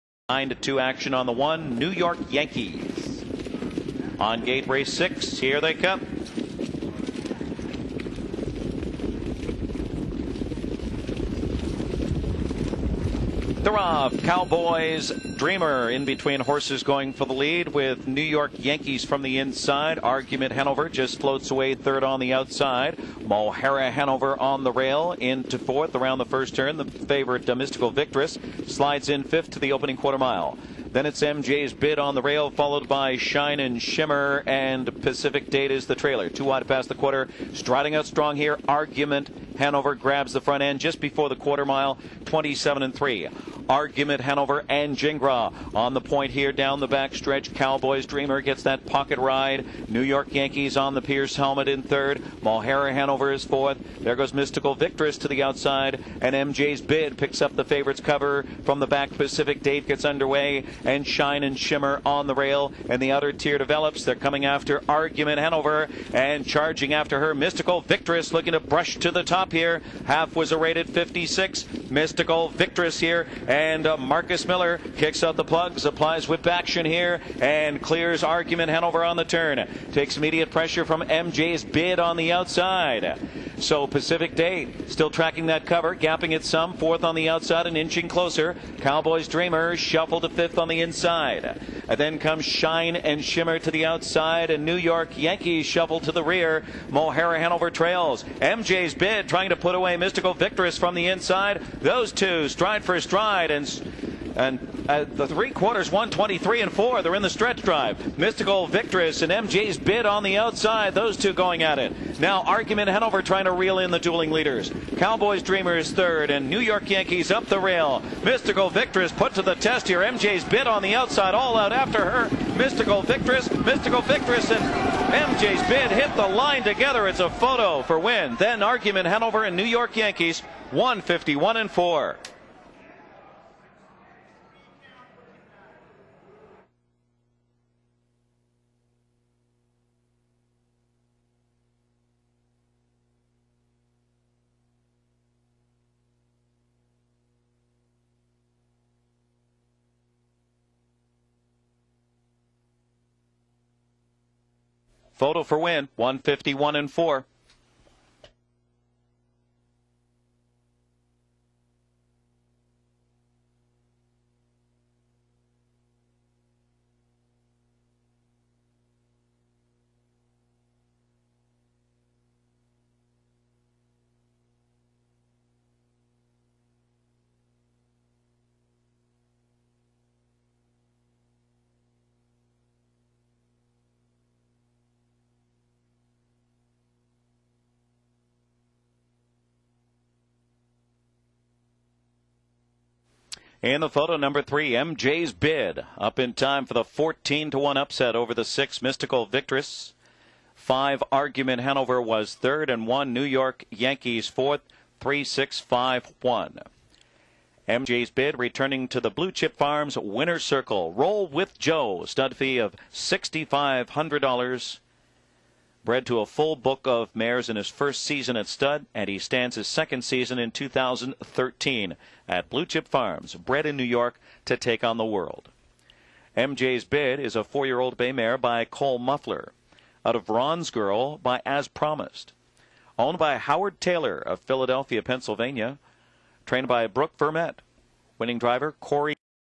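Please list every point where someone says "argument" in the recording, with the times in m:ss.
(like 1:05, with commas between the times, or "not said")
0:20, 0:38, 0:43, 1:04, 1:18, 1:52, 2:08, 3:21.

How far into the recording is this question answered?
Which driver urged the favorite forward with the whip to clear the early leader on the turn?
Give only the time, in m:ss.
1:13.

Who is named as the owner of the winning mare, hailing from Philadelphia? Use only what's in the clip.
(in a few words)
Howard Taylor.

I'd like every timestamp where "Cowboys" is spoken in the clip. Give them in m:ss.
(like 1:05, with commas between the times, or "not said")
0:14, 0:47, 1:28, 1:54.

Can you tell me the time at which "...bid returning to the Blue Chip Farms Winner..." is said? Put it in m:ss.
3:28.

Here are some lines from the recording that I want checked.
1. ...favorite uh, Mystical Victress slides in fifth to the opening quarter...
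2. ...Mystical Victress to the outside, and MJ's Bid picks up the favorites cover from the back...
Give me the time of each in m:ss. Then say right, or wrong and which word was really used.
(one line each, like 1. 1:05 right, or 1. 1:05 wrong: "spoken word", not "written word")
1. 0:26 right
2. 0:54 right.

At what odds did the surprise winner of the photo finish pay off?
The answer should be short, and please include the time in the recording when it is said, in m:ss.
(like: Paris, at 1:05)
14 to 1, at 3:16.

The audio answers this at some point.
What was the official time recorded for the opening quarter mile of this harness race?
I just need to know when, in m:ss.
0:42.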